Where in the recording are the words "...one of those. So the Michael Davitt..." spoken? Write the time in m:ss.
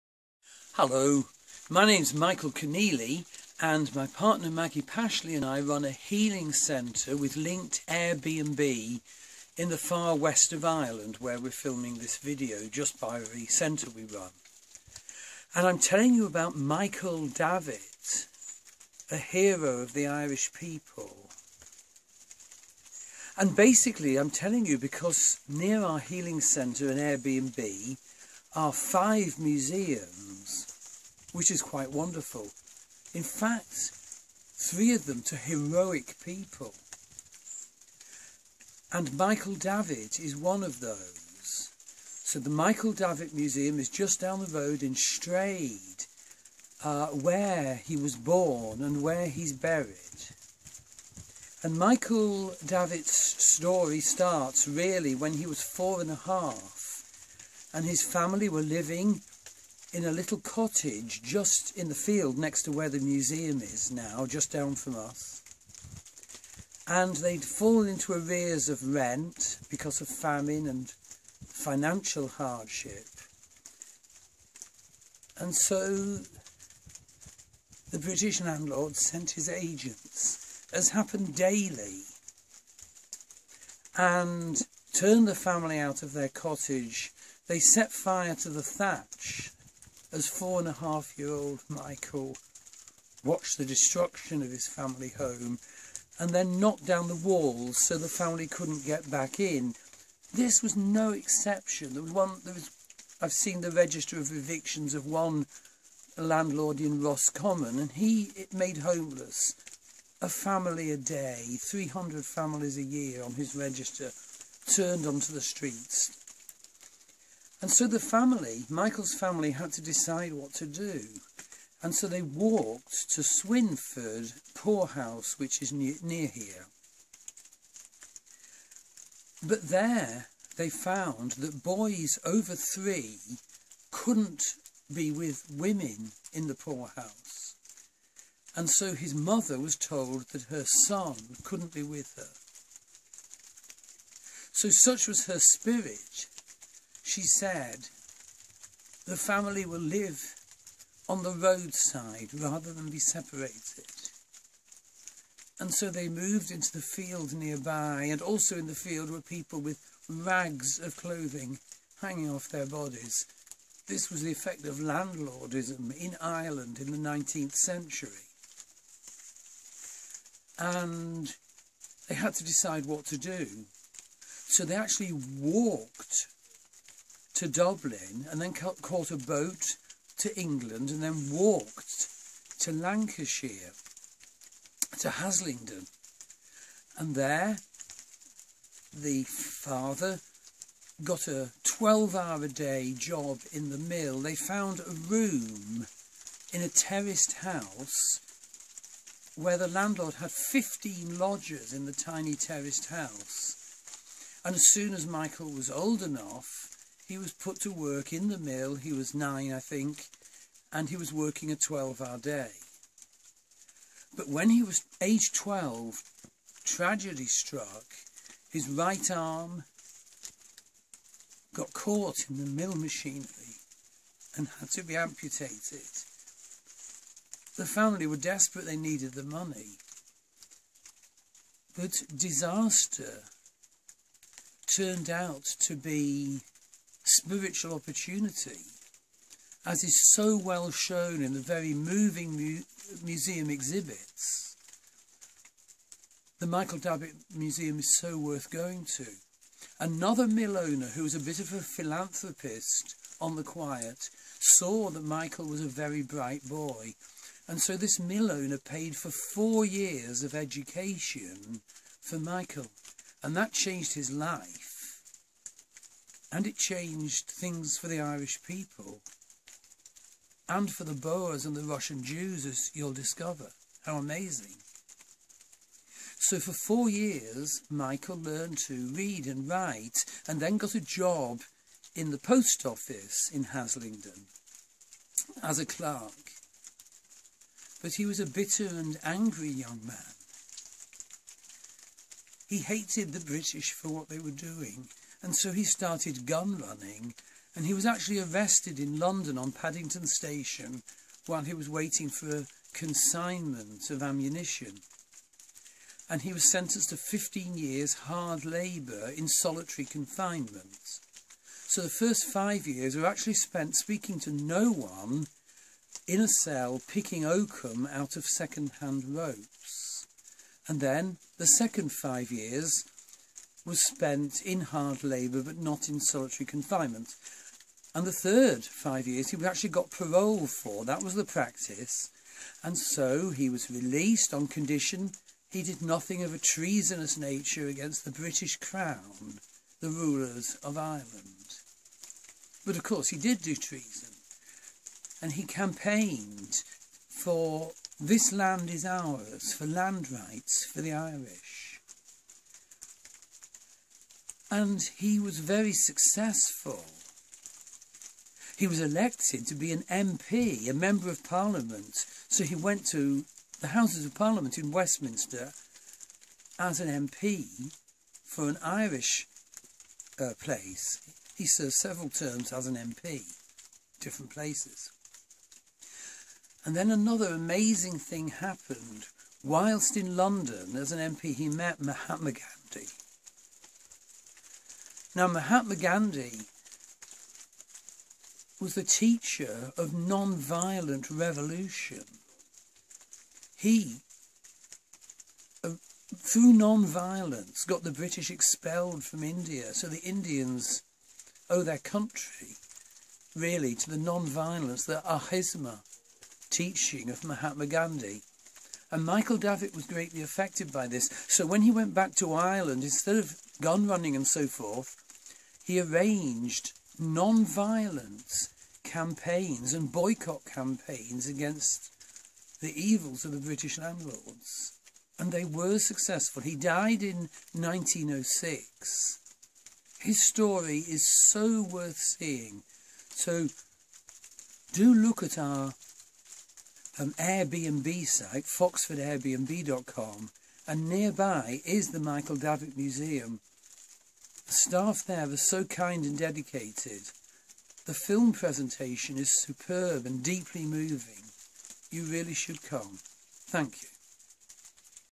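0:40.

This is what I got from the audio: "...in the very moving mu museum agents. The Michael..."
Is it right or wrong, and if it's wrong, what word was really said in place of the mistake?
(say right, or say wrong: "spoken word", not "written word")
wrong: "exhibits", not "agents".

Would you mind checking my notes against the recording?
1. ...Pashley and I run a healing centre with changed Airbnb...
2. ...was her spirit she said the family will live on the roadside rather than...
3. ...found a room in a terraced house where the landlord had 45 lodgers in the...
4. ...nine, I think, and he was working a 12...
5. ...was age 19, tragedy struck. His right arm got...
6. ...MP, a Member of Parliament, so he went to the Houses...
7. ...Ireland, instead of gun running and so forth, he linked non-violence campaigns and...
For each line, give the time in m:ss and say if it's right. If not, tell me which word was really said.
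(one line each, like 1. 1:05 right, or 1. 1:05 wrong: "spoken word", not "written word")
1. 0:04 wrong: "linked", not "changed"
2. 2:25 right
3. 3:14 wrong: "15", not "45"
4. 3:29 right
5. 3:34 wrong: "12", not "19"
6. 5:59 right
7. 6:52 wrong: "arranged", not "linked".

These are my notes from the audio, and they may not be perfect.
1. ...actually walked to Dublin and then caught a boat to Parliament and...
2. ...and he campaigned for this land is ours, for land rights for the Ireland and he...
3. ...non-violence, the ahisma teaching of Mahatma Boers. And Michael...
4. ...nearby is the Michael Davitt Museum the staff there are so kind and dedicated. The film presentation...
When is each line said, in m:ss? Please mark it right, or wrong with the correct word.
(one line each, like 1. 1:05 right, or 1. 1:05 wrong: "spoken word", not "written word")
1. 2:54 wrong: "England", not "Parliament"
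2. 5:45 wrong: "Irish", not "Ireland"
3. 6:43 wrong: "Gandhi", not "Boers"
4. 7:20 right.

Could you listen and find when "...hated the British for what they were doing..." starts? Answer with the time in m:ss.
4:52.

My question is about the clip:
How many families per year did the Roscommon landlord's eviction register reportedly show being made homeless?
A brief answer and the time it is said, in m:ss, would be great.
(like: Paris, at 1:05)
300, at 1:51.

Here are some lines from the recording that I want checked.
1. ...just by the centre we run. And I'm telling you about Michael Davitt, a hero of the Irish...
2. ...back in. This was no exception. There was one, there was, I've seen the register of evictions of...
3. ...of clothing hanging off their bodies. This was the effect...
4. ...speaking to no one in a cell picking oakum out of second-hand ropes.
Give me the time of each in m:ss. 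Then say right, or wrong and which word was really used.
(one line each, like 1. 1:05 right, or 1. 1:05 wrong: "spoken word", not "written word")
1. 0:12 right
2. 1:39 right
3. 2:40 right
4. 5:13 right.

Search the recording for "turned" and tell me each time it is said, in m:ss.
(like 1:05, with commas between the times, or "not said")
1:24, 1:54, 3:54.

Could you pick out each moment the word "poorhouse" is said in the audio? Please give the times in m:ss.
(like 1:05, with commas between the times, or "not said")
2:04, 2:16.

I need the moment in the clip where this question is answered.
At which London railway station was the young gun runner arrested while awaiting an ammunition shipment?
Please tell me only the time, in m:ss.
4:59.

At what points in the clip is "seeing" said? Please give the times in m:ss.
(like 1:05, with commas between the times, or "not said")
7:11.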